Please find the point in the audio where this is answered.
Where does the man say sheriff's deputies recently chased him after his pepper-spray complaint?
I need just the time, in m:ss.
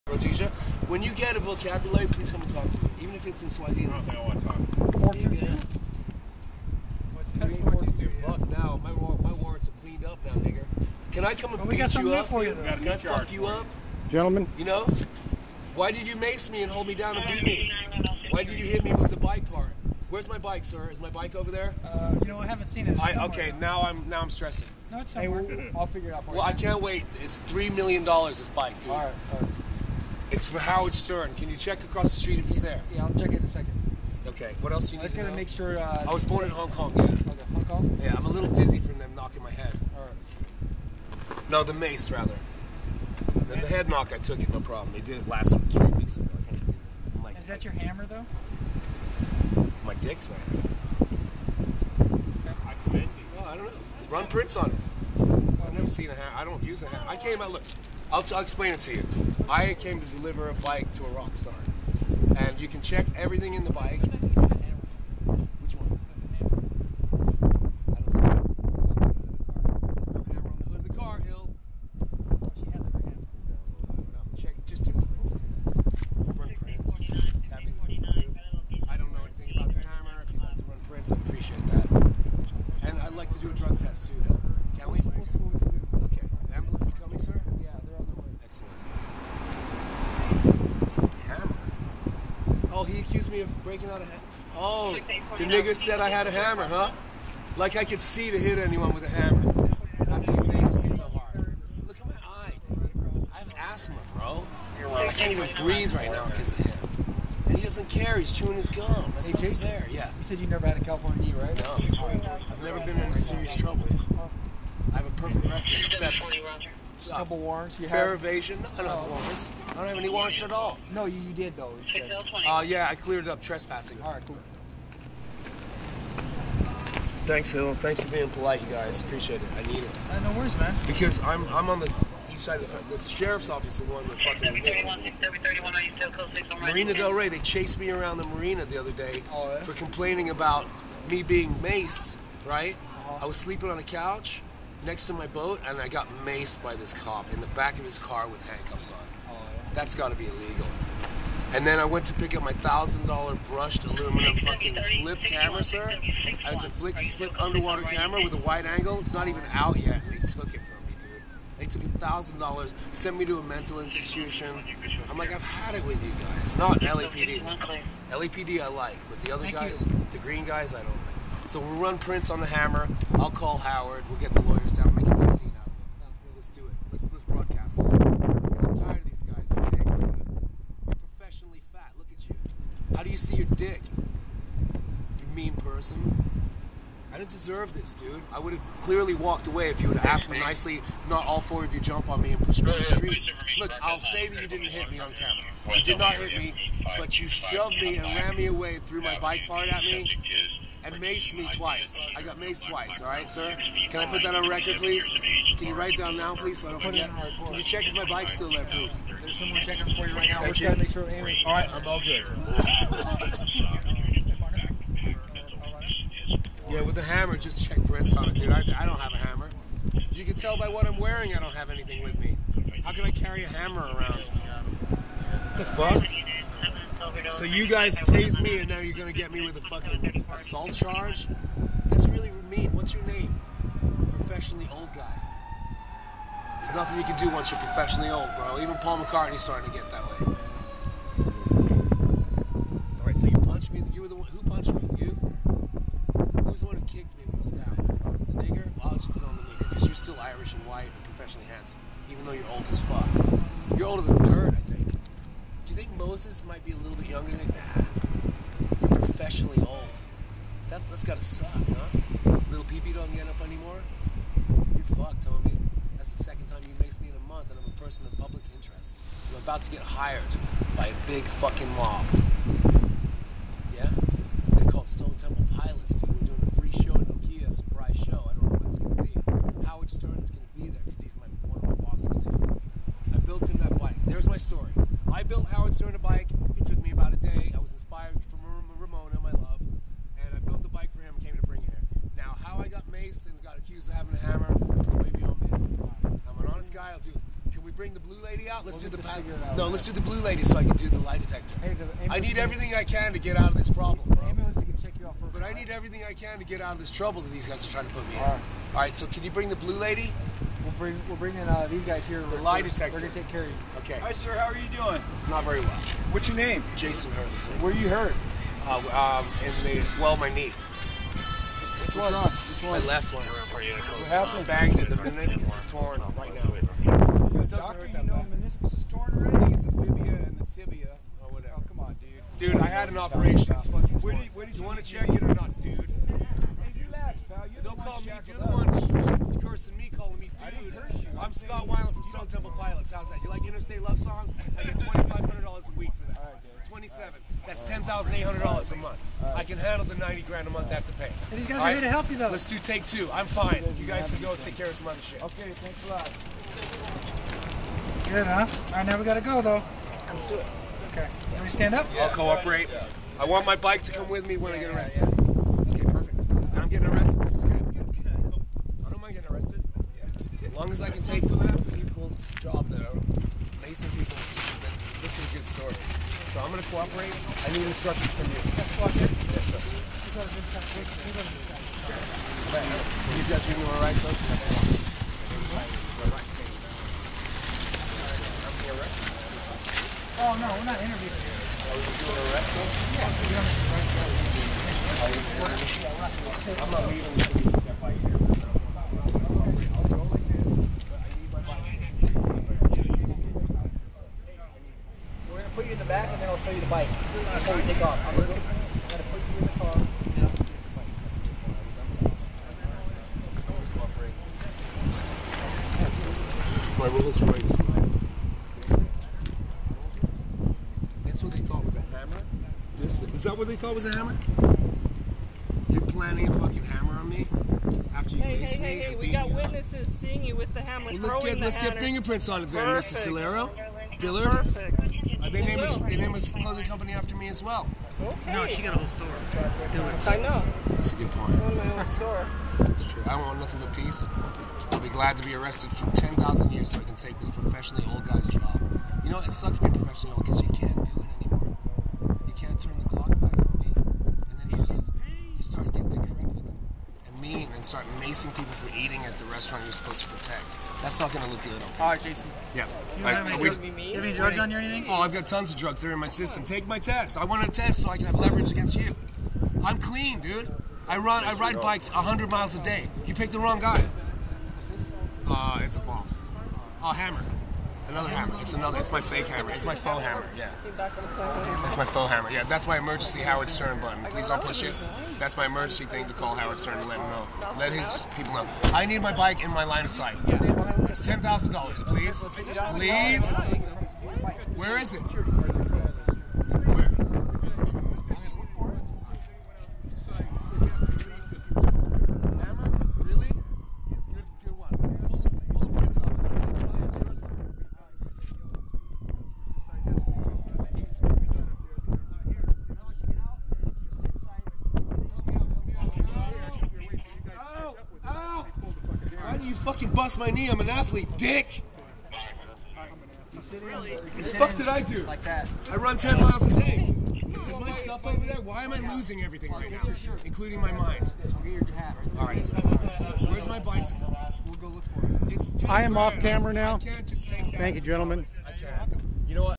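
2:16.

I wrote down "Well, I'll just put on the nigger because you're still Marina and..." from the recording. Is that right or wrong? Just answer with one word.
wrong.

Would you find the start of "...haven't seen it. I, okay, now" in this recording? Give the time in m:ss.
0:22.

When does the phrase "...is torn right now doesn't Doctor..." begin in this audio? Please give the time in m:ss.
5:25.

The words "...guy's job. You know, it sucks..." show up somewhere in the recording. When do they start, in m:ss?
7:28.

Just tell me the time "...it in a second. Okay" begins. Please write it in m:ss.
0:33.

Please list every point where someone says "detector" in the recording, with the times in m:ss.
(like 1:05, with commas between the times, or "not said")
5:01, 5:12.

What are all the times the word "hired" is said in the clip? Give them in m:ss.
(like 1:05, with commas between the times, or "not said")
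4:29.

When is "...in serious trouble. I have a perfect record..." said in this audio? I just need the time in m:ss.
1:52.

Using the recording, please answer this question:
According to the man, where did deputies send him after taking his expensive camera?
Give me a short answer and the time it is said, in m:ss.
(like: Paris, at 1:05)
A mental institution, at 2:43.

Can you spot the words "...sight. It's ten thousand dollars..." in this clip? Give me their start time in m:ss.
8:09.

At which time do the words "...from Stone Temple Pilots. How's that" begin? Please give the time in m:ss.
5:41.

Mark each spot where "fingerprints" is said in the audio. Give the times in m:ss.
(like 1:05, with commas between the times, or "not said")
7:11.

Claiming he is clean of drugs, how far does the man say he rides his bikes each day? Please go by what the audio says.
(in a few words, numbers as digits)
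100 miles.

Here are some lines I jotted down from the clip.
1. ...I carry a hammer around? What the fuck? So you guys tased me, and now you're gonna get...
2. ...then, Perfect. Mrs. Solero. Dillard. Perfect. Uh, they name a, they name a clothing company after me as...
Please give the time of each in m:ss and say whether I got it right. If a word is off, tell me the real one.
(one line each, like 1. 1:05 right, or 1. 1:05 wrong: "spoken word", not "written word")
1. 3:43 right
2. 7:12 right.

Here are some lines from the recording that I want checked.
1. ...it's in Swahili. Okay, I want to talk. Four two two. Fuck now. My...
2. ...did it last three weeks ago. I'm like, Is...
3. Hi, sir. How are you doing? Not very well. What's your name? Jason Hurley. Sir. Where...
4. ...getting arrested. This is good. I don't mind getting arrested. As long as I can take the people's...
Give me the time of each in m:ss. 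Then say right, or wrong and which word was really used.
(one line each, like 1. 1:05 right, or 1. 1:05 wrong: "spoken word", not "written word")
1. 0:03 right
2. 0:45 right
3. 5:13 right
4. 6:06 right.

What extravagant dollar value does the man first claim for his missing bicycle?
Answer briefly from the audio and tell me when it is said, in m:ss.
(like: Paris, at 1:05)
3 million dollars, at 0:27.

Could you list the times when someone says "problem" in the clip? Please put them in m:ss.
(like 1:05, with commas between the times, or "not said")
0:44, 5:03.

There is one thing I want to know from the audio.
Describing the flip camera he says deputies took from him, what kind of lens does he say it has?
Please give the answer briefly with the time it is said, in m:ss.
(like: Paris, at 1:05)
Wide angle, at 2:38.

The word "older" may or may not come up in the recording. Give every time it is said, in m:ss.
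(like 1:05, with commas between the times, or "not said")
4:13.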